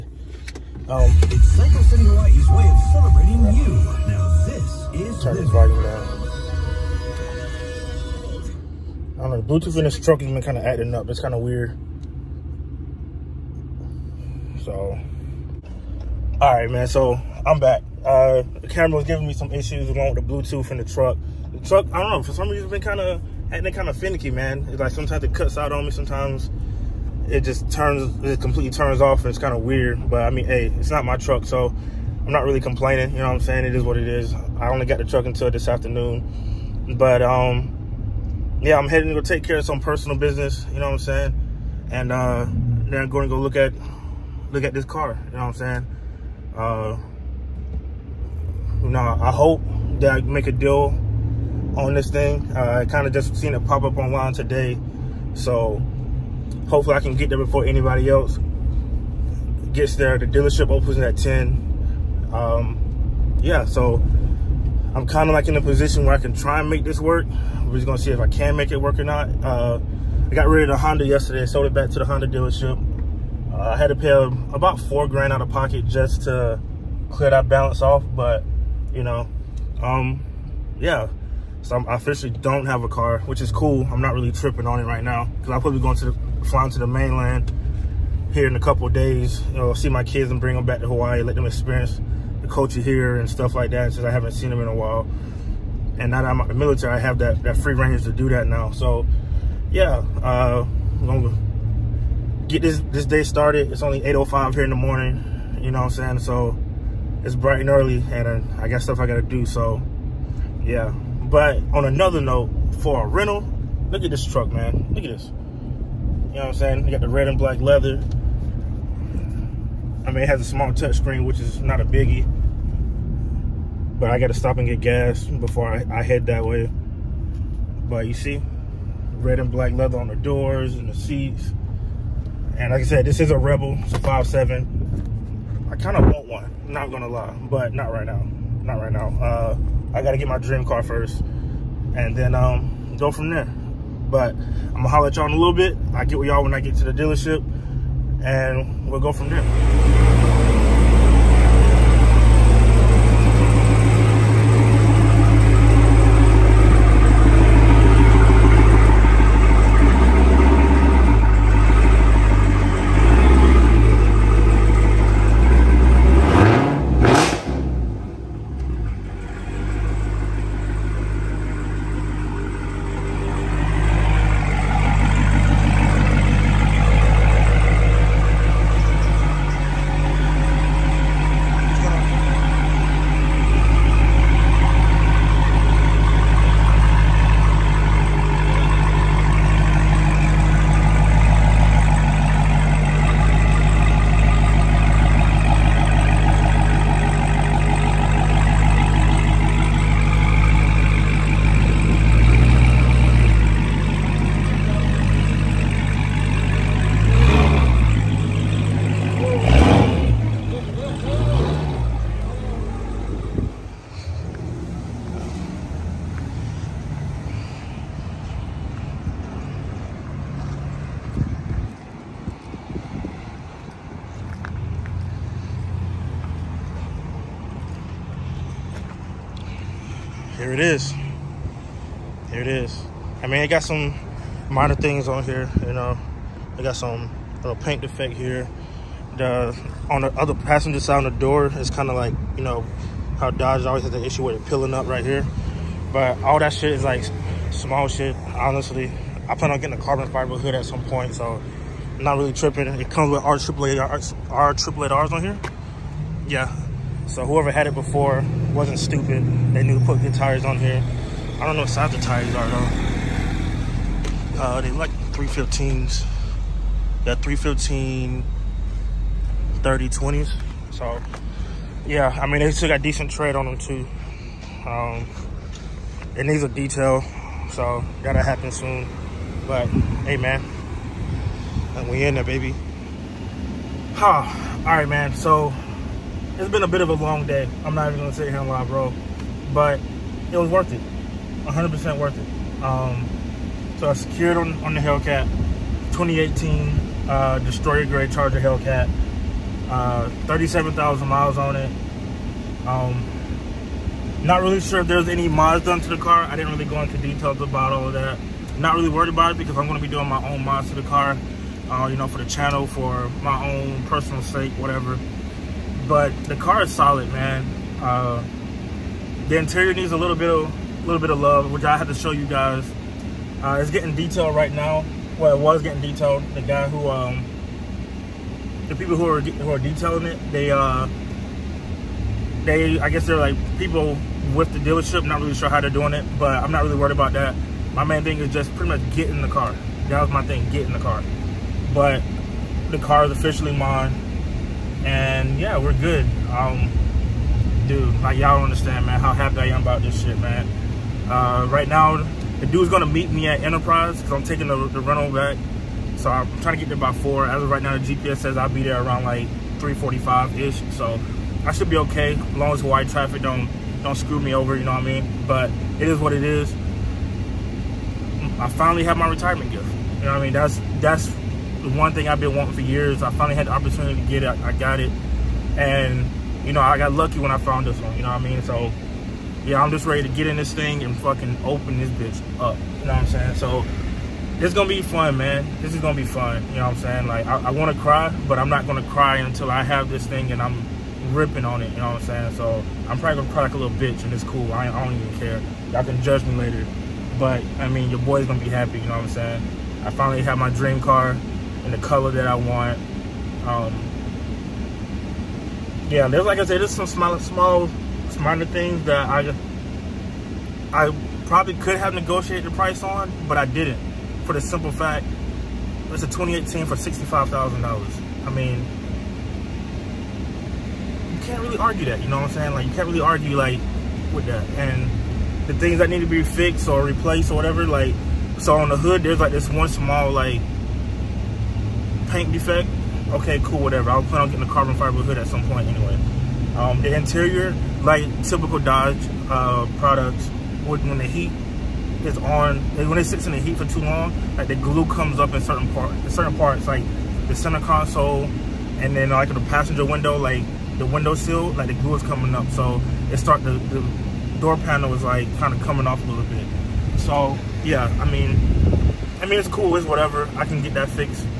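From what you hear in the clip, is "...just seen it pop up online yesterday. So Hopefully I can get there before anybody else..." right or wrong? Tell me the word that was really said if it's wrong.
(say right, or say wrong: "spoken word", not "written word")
wrong: "today", not "yesterday".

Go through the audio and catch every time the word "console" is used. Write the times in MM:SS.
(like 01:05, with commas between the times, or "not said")
07:27.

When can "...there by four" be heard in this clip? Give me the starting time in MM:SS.
05:56.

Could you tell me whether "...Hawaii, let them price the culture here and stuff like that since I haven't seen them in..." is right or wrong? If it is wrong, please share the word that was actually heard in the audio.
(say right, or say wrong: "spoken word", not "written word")
wrong: "experience", not "price".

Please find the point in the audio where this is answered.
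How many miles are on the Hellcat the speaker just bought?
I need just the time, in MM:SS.
05:00.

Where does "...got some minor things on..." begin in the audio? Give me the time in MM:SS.
03:53.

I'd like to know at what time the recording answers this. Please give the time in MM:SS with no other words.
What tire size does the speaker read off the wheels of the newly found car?
04:27.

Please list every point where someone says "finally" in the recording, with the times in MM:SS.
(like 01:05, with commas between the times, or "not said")
06:08, 06:13, 06:39.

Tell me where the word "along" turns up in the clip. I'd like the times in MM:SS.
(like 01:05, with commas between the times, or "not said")
00:19.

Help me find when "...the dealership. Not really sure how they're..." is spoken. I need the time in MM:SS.
05:34.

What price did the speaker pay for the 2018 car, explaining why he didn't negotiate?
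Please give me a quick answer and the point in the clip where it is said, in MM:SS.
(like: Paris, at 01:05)
$65,000, at 06:56.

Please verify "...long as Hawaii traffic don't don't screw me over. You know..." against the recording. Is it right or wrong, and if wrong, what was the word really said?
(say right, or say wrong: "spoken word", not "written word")
right.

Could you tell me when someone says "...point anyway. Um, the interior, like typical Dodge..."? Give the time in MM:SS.
07:15.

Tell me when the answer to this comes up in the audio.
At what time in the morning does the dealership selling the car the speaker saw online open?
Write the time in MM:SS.
01:01.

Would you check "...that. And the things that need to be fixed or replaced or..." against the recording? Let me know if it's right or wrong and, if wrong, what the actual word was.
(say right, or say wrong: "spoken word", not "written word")
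right.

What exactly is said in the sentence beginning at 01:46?
So it's bright and early and uh, I got stuff I gotta do, so yeah.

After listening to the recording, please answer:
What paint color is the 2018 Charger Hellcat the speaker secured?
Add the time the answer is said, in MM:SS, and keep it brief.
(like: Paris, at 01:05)
Destroyer Grey, at 04:57.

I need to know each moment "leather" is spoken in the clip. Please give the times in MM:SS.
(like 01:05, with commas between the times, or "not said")
01:57, 02:09.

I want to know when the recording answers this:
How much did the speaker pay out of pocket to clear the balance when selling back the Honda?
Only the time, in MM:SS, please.
01:14.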